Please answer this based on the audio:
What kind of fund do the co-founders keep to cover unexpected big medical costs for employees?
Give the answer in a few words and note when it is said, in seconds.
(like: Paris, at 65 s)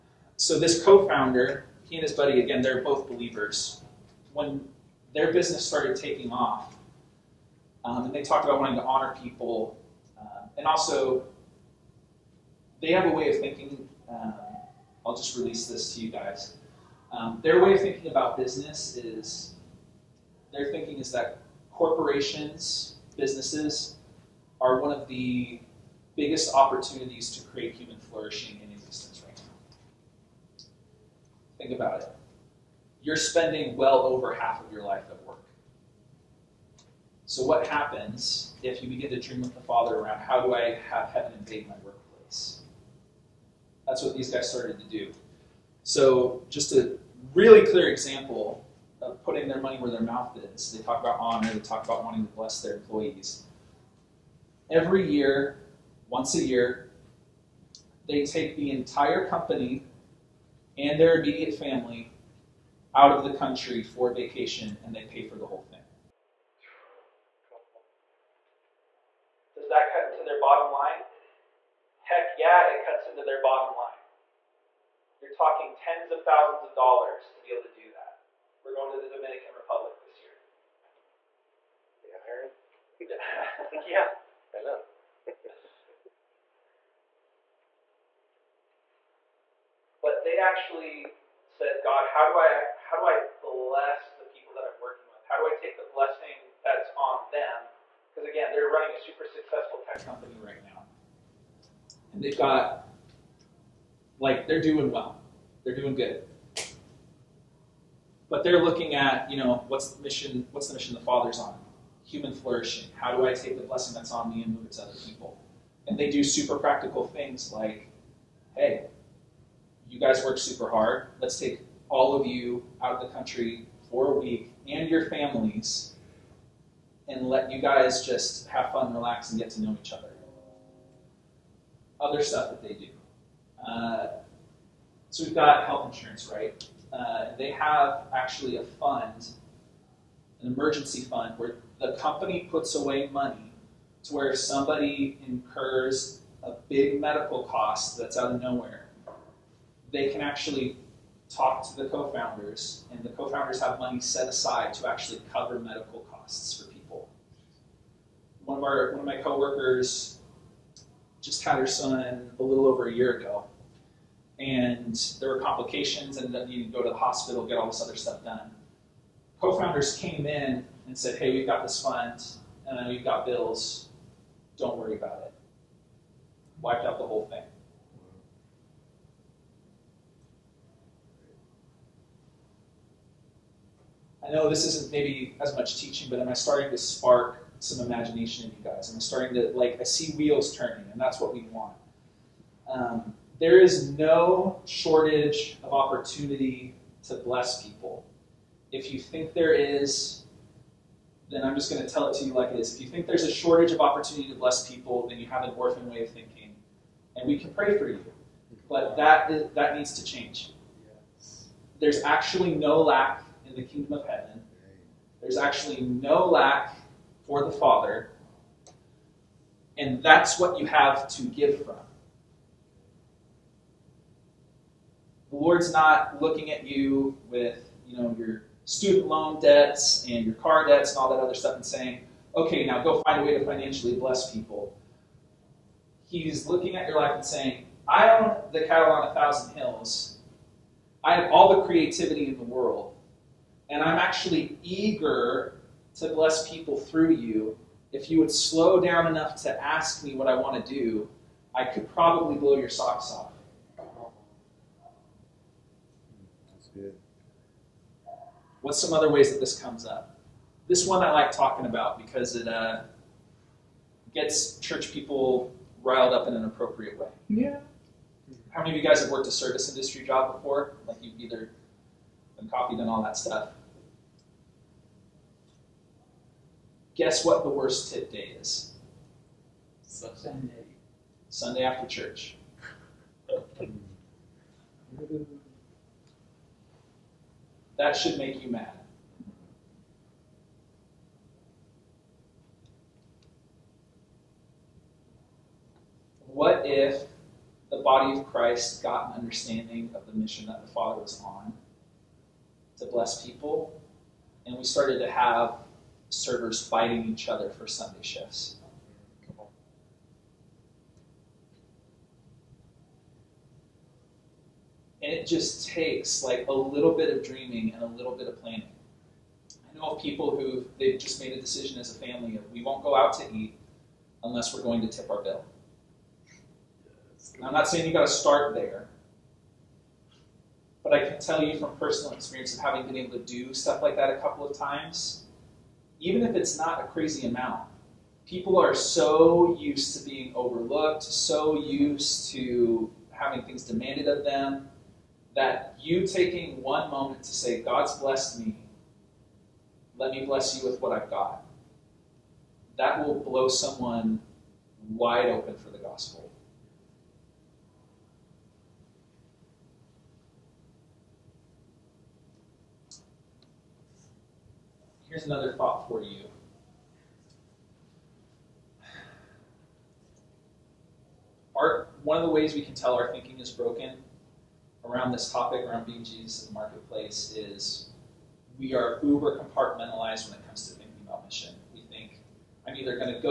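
emergency fund, at 140 s.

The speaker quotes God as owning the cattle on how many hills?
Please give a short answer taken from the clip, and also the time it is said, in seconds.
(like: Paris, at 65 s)
1000, at 239 s.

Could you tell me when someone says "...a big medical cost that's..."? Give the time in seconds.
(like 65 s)
146 s.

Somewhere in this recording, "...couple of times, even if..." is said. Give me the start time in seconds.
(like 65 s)
334 s.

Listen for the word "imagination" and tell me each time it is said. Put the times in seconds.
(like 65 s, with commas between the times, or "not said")
187 s.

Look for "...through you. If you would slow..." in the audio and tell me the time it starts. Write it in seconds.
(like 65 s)
246 s.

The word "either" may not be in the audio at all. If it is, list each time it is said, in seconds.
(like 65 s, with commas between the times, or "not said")
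271 s, 382 s.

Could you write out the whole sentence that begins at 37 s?
So, what happens if you begin to dream with the Father around how do I have heaven invade my workplace?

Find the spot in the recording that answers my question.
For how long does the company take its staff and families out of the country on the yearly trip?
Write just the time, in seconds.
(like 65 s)
124 s.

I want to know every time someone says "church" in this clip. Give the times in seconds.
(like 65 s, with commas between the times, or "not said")
264 s, 281 s.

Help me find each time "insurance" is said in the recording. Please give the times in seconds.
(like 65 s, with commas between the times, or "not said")
135 s.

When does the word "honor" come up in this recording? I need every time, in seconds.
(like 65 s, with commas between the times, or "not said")
8 s, 51 s.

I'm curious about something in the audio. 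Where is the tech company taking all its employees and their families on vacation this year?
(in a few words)
Dominican Republic.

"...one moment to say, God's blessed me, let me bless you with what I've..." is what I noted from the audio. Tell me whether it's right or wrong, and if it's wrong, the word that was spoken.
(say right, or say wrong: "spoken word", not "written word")
right.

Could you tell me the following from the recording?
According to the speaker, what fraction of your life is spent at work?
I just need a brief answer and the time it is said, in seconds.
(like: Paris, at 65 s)
over half, at 33 s.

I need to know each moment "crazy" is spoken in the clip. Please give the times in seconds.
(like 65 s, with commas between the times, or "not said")
336 s.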